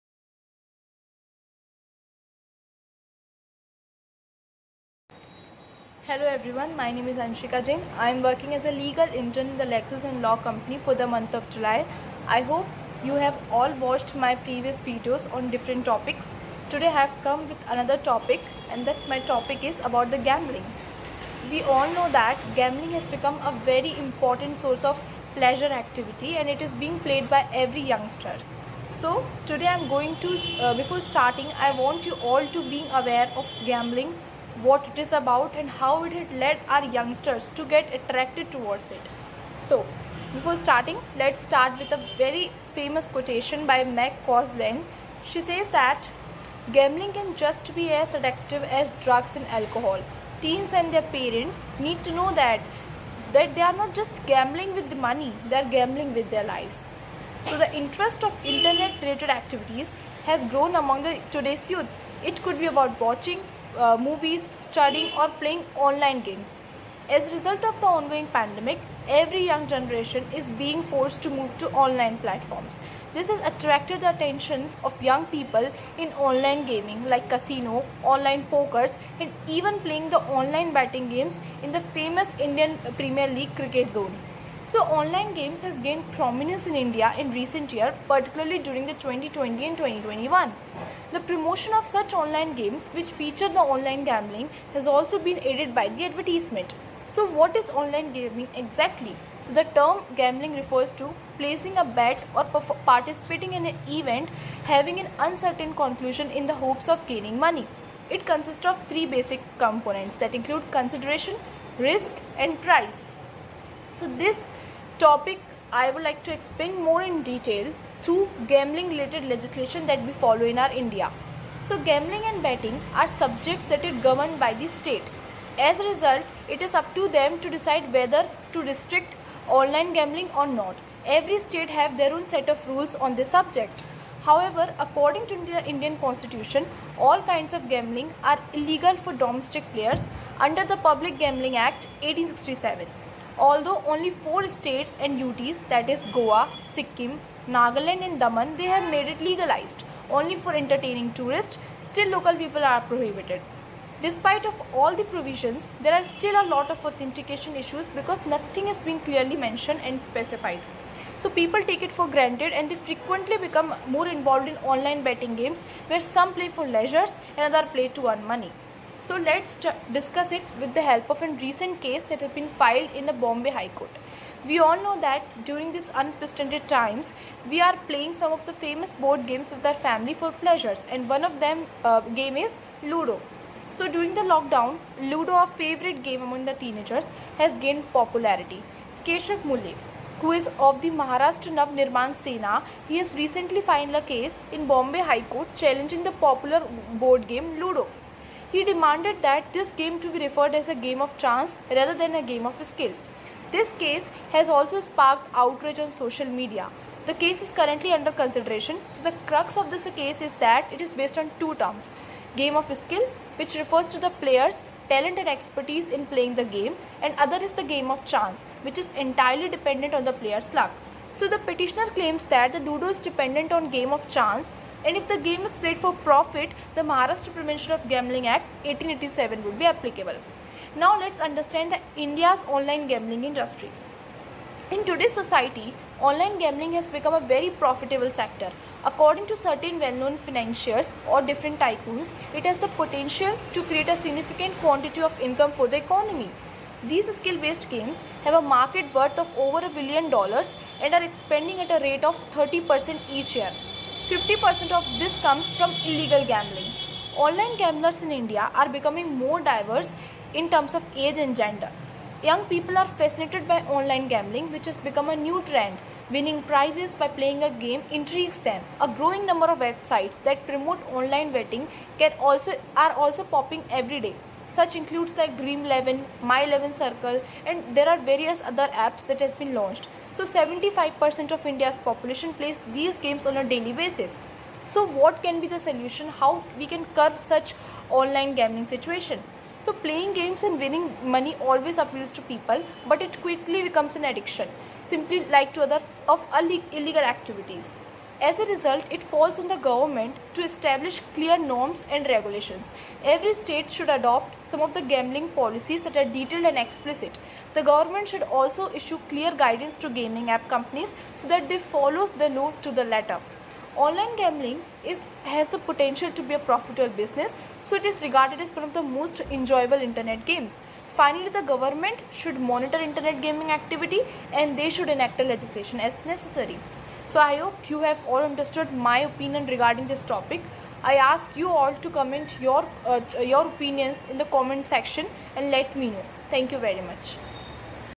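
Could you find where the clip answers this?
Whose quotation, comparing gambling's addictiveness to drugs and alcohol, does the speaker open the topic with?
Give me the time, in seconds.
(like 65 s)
43 s.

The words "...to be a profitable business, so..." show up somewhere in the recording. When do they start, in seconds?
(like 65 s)
316 s.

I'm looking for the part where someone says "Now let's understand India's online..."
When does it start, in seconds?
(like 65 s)
230 s.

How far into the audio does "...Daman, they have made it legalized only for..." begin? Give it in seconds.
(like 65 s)
148 s.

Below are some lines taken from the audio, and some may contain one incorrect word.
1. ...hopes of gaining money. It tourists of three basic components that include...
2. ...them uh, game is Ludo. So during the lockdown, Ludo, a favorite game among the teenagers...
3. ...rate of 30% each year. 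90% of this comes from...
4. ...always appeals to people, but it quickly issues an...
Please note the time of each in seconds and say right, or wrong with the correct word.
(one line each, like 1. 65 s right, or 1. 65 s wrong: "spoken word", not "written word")
1. 106 s wrong: "consists", not "tourists"
2. 181 s right
3. 251 s wrong: "50", not "90"
4. 291 s wrong: "becomes", not "issues".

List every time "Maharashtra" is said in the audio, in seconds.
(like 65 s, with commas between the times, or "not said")
190 s, 226 s.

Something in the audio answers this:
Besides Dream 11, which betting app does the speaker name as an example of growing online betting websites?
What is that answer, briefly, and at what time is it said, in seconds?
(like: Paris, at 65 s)
My 11 Circle, at 276 s.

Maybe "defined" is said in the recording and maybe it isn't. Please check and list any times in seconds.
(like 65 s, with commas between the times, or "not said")
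not said.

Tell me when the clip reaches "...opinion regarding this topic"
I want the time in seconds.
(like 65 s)
328 s.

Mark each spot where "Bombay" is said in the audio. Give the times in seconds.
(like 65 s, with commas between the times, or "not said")
173 s, 194 s.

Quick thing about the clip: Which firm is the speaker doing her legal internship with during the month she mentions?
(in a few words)
Lexis and Law Company.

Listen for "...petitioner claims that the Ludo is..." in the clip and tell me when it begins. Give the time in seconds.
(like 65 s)
221 s.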